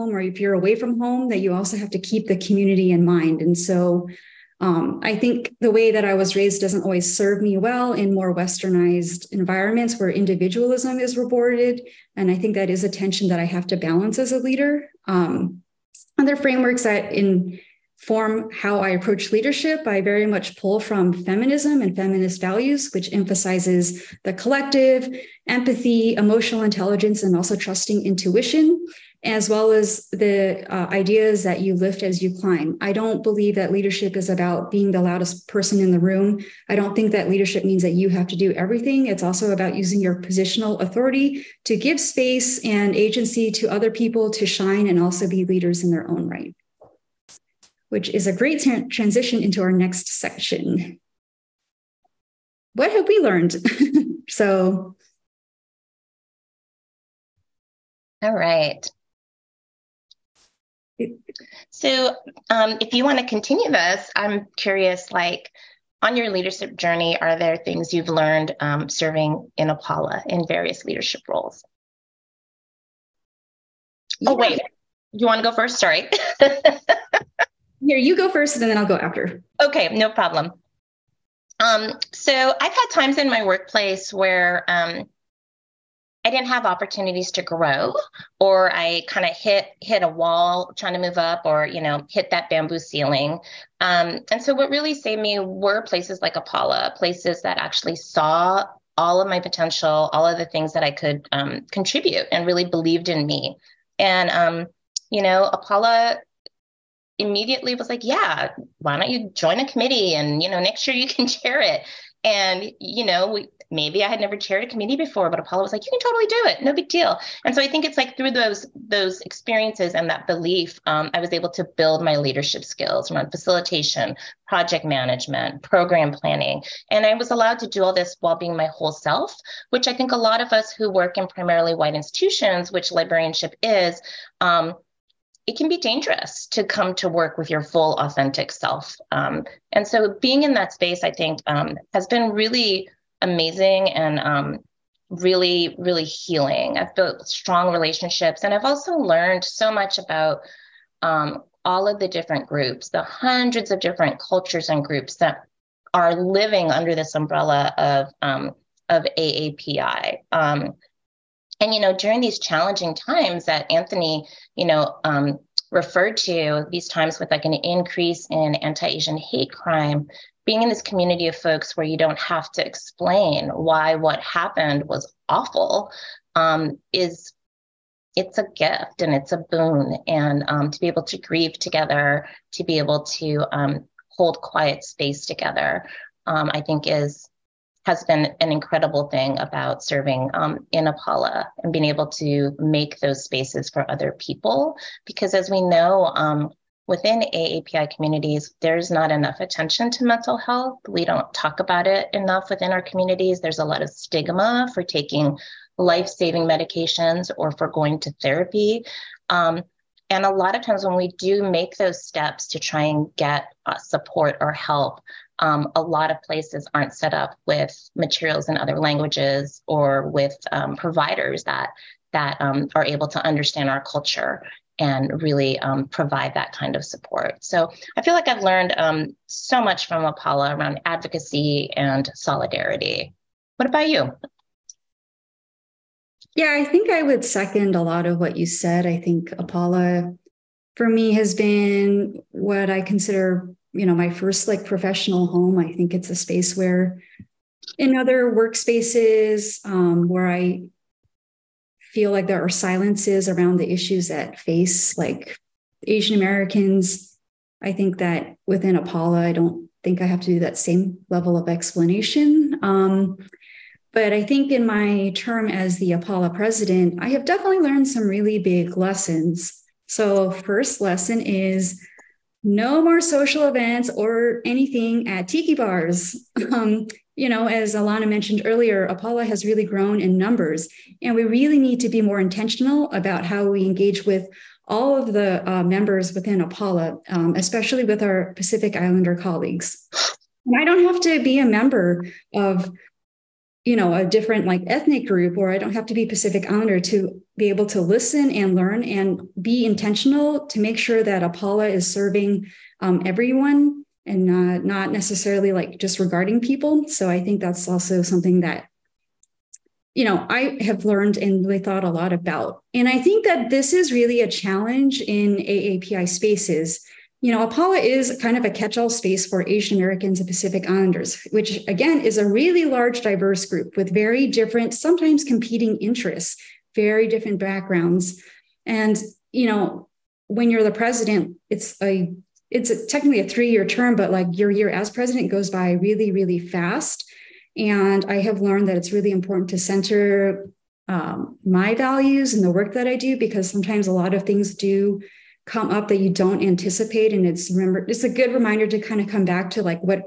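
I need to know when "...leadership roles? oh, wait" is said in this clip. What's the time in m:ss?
1:10.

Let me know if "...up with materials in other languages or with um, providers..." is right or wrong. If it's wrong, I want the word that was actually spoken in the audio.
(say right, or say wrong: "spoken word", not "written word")
right.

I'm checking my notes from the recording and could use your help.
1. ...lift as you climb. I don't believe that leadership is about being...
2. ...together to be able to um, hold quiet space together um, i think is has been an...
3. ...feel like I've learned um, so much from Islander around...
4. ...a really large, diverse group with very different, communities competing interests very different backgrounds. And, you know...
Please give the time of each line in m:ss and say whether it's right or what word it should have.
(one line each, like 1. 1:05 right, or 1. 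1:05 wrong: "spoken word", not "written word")
1. 0:31 right
2. 3:01 right
3. 3:48 wrong: "Apala", not "Islander"
4. 5:22 wrong: "sometimes", not "communities".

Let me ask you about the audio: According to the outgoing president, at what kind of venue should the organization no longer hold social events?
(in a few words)
tiki bars.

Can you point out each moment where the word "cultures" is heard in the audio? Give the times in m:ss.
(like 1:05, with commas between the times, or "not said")
2:34, 3:43.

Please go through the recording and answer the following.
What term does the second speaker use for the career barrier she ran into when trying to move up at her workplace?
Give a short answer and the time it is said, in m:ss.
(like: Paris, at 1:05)
bamboo ceiling, at 1:32.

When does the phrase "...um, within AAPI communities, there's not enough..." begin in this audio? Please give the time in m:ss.
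3:16.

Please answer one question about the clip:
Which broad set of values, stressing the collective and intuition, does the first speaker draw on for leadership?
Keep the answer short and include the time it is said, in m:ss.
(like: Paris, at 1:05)
feminism, at 0:21.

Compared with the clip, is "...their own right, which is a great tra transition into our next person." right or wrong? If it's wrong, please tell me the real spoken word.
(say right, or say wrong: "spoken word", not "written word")
wrong: "section", not "person".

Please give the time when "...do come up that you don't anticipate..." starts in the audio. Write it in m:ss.
5:44.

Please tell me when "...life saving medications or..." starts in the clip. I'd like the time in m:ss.
3:25.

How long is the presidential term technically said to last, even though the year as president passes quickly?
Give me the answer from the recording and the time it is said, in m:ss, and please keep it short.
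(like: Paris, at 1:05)
3 years, at 5:33.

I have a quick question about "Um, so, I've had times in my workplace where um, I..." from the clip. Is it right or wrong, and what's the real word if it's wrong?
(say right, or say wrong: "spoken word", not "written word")
right.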